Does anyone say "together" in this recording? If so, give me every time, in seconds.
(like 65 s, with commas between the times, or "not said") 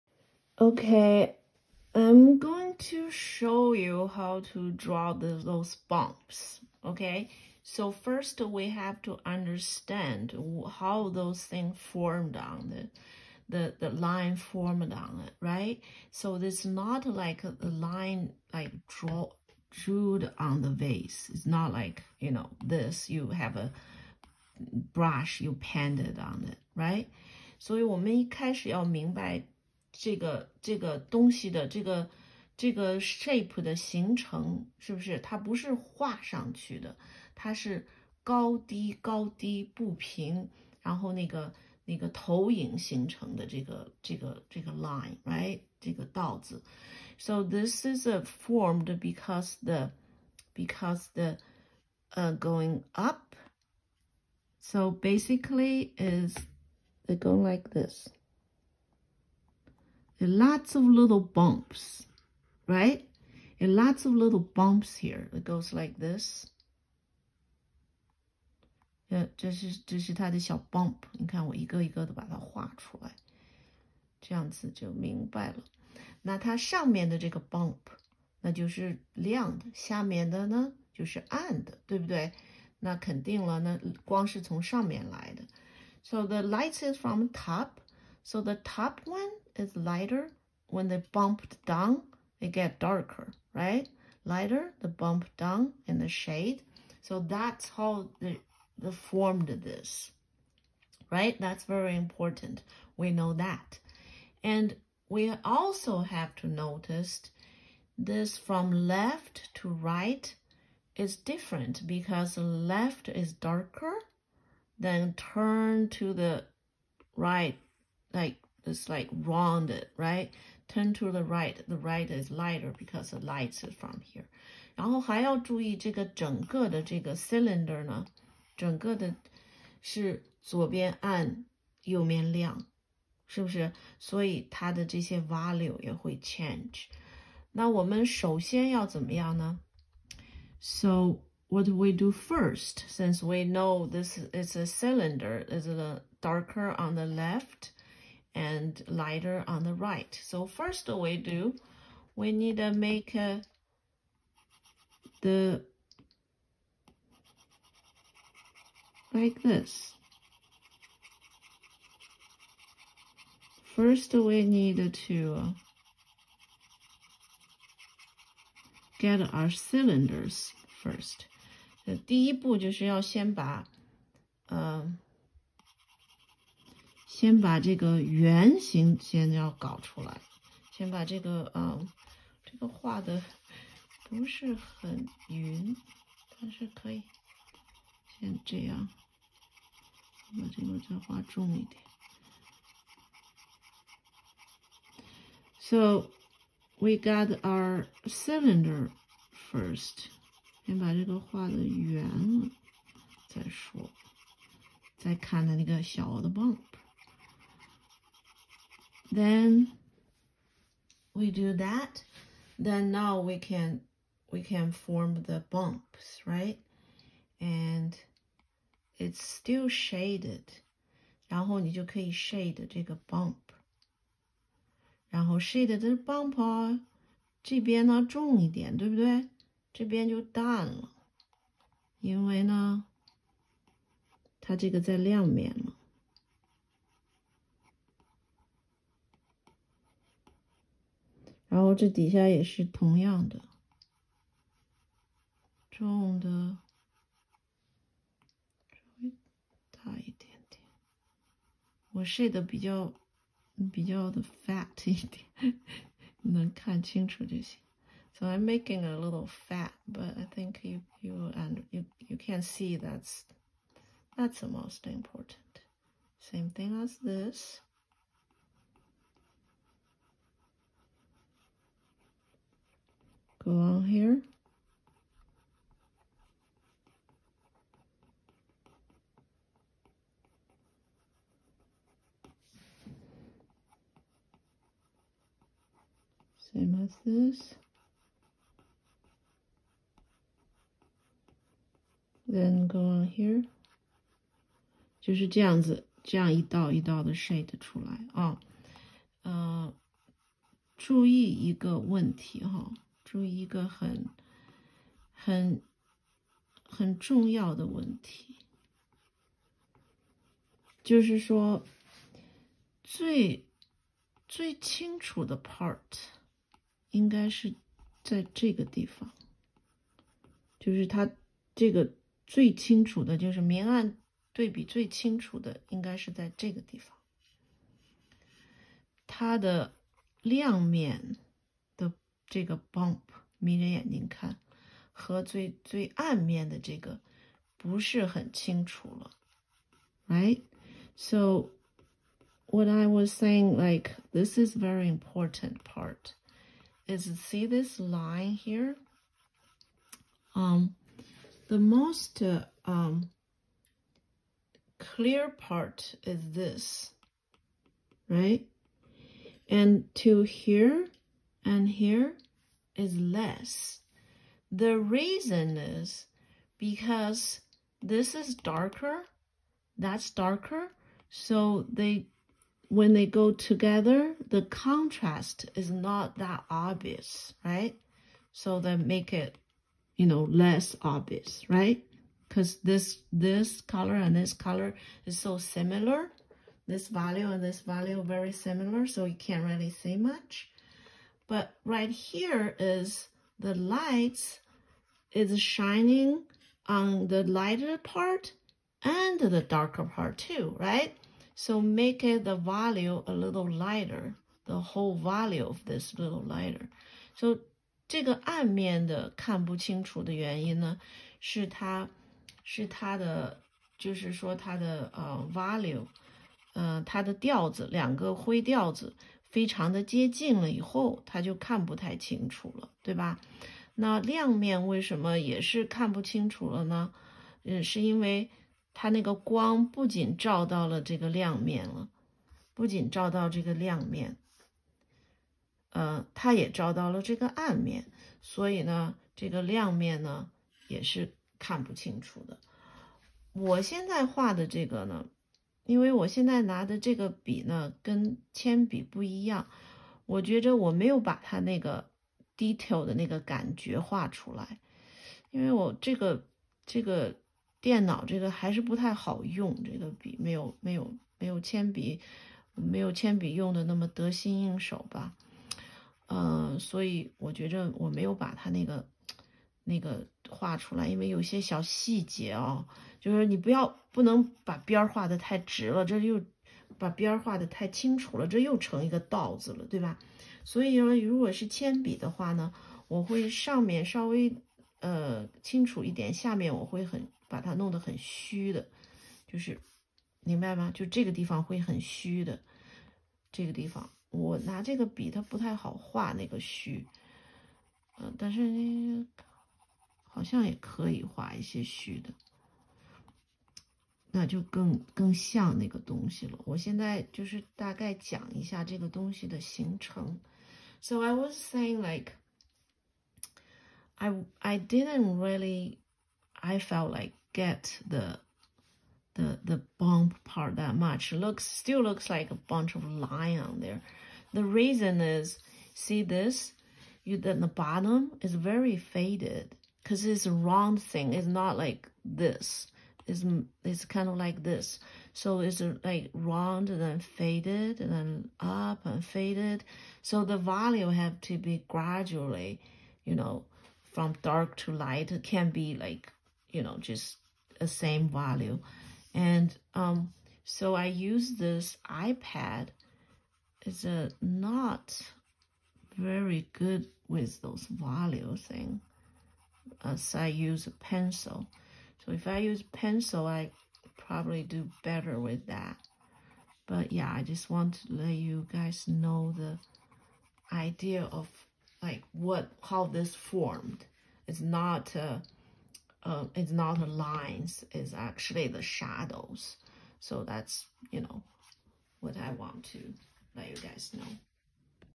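373 s.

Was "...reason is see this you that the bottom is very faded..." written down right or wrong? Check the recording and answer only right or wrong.
right.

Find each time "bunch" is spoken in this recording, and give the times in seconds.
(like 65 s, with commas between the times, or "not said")
522 s.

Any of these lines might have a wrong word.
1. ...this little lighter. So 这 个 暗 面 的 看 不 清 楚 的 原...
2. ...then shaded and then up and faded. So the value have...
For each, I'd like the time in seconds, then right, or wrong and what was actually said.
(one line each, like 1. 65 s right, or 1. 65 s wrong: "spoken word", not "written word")
1. 405 s right
2. 536 s wrong: "faded", not "shaded".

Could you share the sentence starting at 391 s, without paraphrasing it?
But right here is the lights is shining on the lighter part and the darker part too, right?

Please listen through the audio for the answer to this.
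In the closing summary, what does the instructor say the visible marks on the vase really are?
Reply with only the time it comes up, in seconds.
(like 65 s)
578 s.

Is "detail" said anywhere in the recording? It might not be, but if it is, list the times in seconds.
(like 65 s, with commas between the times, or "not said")
452 s.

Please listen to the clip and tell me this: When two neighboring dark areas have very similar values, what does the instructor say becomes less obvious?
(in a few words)
The contrast.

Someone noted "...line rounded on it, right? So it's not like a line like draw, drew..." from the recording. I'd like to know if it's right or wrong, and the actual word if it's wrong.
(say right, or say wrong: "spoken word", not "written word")
wrong: "formed", not "rounded".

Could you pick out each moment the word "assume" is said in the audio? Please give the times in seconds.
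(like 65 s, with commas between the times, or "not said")
not said.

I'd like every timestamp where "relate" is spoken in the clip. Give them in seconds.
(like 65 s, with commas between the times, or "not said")
not said.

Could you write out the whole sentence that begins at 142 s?
Since we know this is a cylinder, is the darker on the left and lighter on the right.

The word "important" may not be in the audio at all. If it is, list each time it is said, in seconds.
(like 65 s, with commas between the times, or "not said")
101 s, 264 s, 344 s.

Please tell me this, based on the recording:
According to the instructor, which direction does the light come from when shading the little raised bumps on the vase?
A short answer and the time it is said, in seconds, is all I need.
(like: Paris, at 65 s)
From top, at 86 s.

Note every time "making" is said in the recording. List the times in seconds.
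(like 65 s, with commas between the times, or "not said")
258 s.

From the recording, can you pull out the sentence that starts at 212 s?
Then now we can we can form the bumps, right?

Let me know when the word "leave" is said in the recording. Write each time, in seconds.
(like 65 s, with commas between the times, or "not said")
not said.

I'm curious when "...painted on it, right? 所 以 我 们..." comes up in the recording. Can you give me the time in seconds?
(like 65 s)
25 s.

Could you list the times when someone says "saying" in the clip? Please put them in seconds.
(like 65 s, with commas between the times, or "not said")
343 s, 511 s.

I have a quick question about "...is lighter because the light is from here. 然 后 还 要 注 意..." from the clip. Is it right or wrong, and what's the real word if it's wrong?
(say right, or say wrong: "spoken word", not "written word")
right.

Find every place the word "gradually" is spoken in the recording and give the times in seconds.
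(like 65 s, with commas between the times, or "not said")
541 s.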